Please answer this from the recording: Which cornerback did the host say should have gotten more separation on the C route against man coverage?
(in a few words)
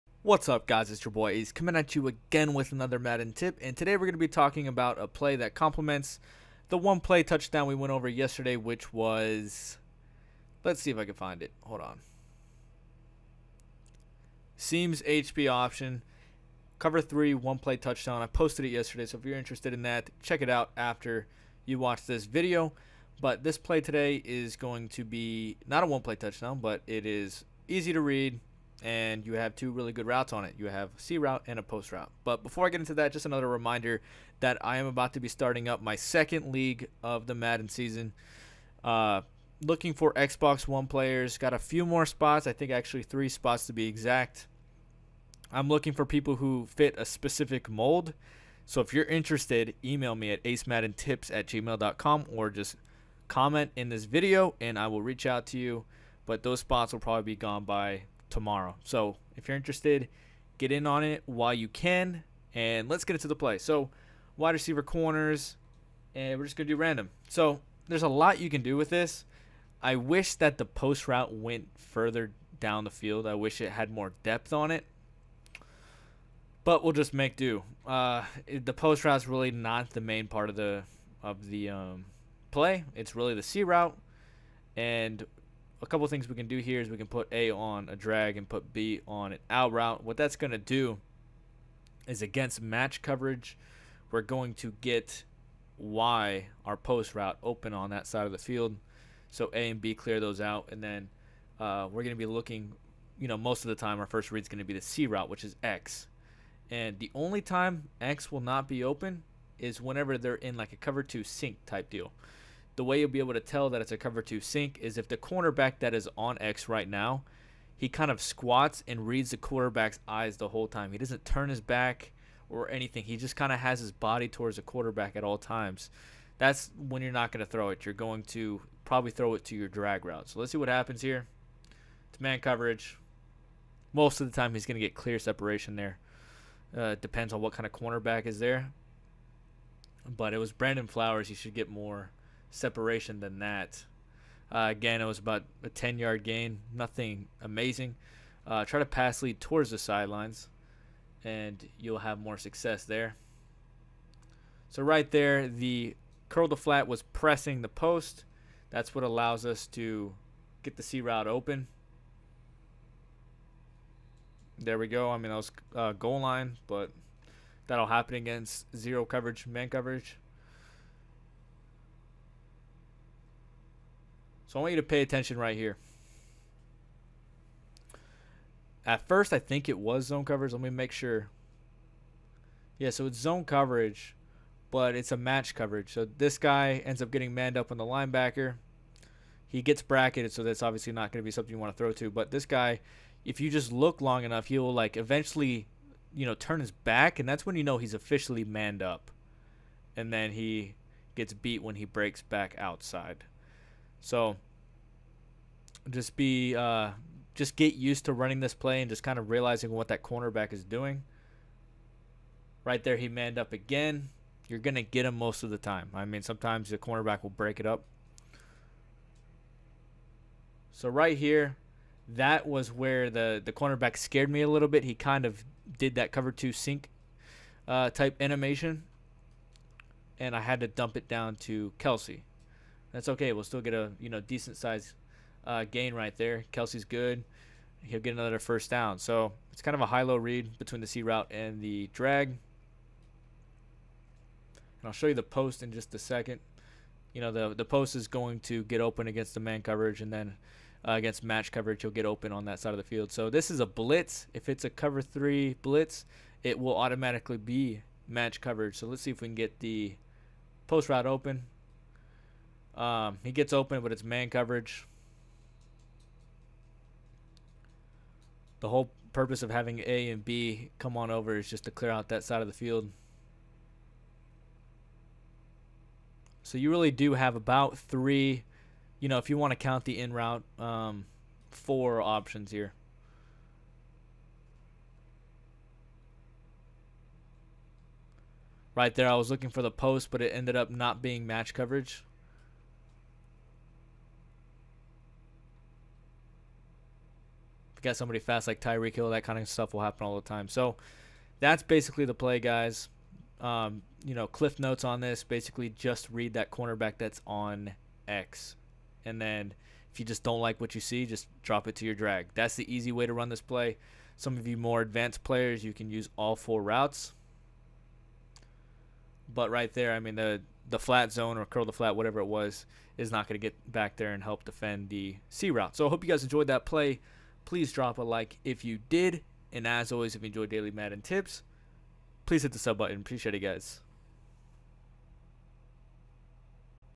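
Brandon Flowers.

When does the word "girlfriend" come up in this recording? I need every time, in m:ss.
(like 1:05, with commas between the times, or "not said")
not said.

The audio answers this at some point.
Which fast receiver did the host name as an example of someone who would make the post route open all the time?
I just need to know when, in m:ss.
4:58.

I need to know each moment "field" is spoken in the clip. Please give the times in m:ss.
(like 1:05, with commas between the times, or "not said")
1:12, 1:38, 4:12, 4:32.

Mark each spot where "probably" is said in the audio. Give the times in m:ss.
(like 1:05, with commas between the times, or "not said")
0:56, 2:08.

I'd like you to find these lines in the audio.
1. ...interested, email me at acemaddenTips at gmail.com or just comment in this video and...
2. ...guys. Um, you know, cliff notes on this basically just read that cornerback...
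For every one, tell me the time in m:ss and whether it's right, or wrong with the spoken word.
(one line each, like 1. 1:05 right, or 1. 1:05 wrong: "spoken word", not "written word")
1. 0:49 right
2. 5:02 right.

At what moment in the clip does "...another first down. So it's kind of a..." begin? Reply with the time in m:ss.
3:58.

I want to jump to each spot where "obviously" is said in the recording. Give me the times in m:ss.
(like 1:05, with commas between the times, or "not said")
3:10.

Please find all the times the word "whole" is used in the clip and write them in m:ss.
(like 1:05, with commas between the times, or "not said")
2:00, 4:28.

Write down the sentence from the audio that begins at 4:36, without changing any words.
So you really do have about three, you know, if you want to count the in route, um, four options here.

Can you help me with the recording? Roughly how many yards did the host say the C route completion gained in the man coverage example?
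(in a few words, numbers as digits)
10.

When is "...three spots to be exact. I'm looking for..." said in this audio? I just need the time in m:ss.
0:43.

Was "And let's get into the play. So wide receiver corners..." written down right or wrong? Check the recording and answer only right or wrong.
right.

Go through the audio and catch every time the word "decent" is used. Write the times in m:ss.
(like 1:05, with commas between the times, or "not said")
3:54.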